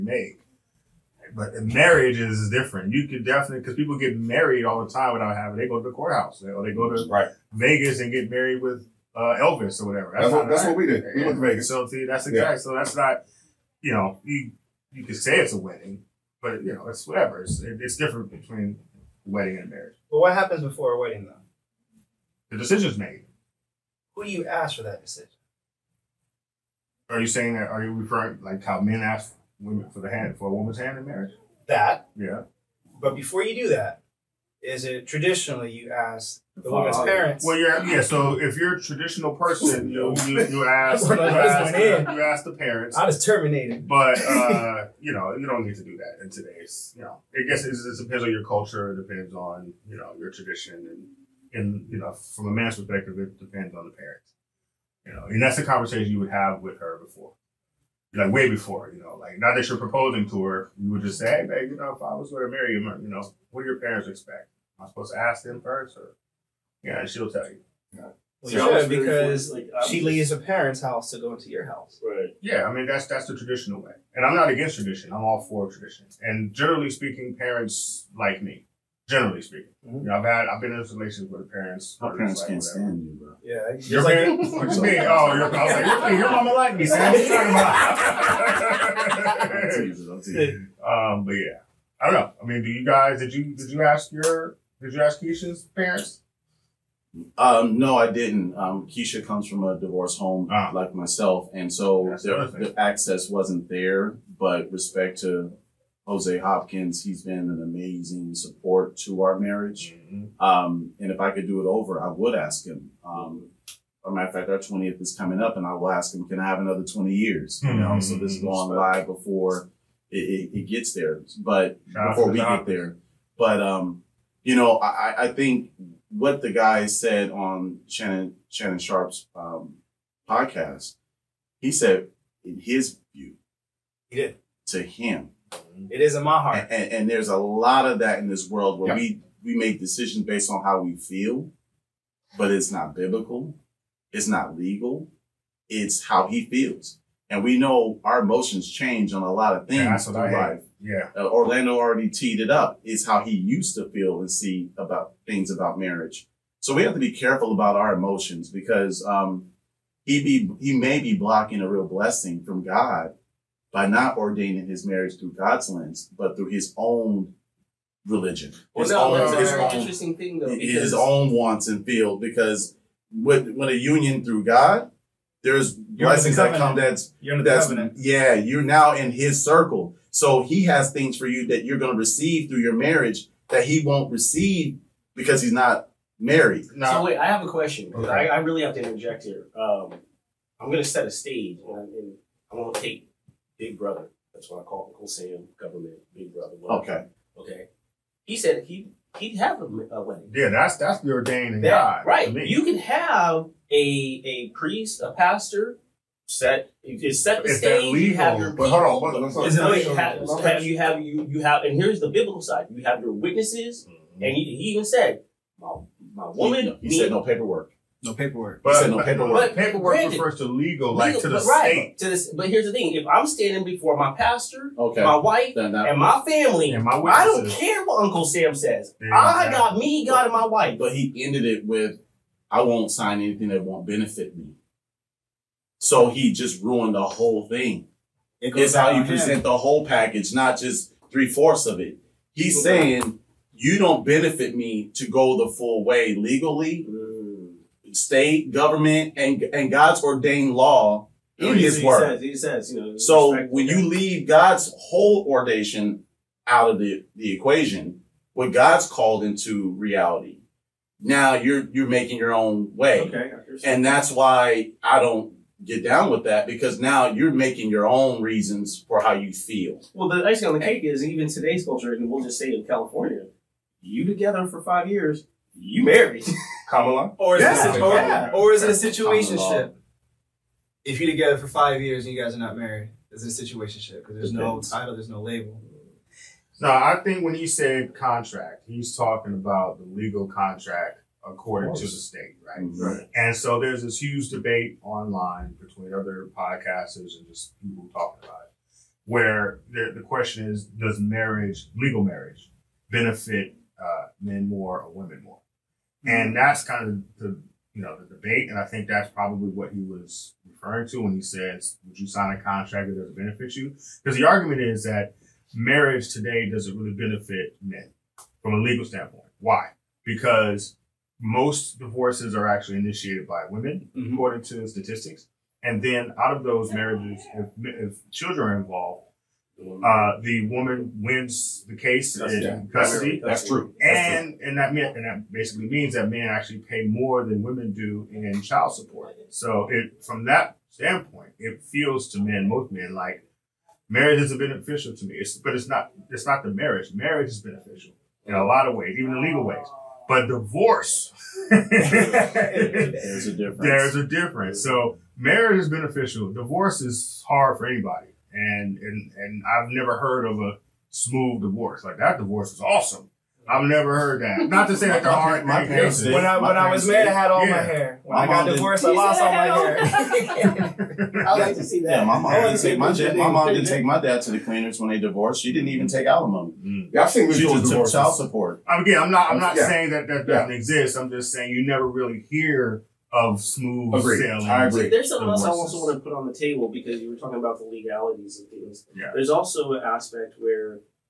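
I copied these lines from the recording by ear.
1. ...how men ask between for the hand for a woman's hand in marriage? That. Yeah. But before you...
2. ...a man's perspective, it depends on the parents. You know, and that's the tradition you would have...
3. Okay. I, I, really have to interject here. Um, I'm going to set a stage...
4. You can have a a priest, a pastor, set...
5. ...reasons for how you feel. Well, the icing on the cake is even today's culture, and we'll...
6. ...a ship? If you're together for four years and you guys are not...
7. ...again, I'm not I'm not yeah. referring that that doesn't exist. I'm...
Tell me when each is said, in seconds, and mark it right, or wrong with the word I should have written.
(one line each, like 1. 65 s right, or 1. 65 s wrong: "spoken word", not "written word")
1. 28 s wrong: "women", not "between"
2. 52 s wrong: "conversation", not "tradition"
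3. 187 s right
4. 202 s right
5. 268 s right
6. 278 s wrong: "five", not "four"
7. 378 s wrong: "saying", not "referring".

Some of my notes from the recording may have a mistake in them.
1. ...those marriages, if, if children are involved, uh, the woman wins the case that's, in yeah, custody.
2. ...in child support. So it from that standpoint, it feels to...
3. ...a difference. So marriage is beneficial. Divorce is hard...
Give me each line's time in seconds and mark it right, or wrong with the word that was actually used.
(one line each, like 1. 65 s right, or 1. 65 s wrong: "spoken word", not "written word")
1. 326 s right
2. 338 s right
3. 353 s right.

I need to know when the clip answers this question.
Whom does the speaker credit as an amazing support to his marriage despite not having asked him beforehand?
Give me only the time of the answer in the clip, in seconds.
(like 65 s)
106 s.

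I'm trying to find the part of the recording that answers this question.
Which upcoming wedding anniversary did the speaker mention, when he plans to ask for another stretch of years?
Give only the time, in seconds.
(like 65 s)
114 s.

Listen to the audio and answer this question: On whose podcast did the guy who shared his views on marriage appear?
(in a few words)
Shannon Sharpe.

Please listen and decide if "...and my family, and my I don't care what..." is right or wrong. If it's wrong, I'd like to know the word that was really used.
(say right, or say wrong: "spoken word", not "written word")
right.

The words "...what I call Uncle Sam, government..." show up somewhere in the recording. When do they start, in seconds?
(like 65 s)
194 s.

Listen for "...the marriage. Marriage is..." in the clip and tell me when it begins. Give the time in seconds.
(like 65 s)
346 s.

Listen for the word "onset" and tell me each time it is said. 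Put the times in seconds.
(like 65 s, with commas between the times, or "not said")
not said.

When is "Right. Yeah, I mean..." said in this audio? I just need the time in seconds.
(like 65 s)
72 s.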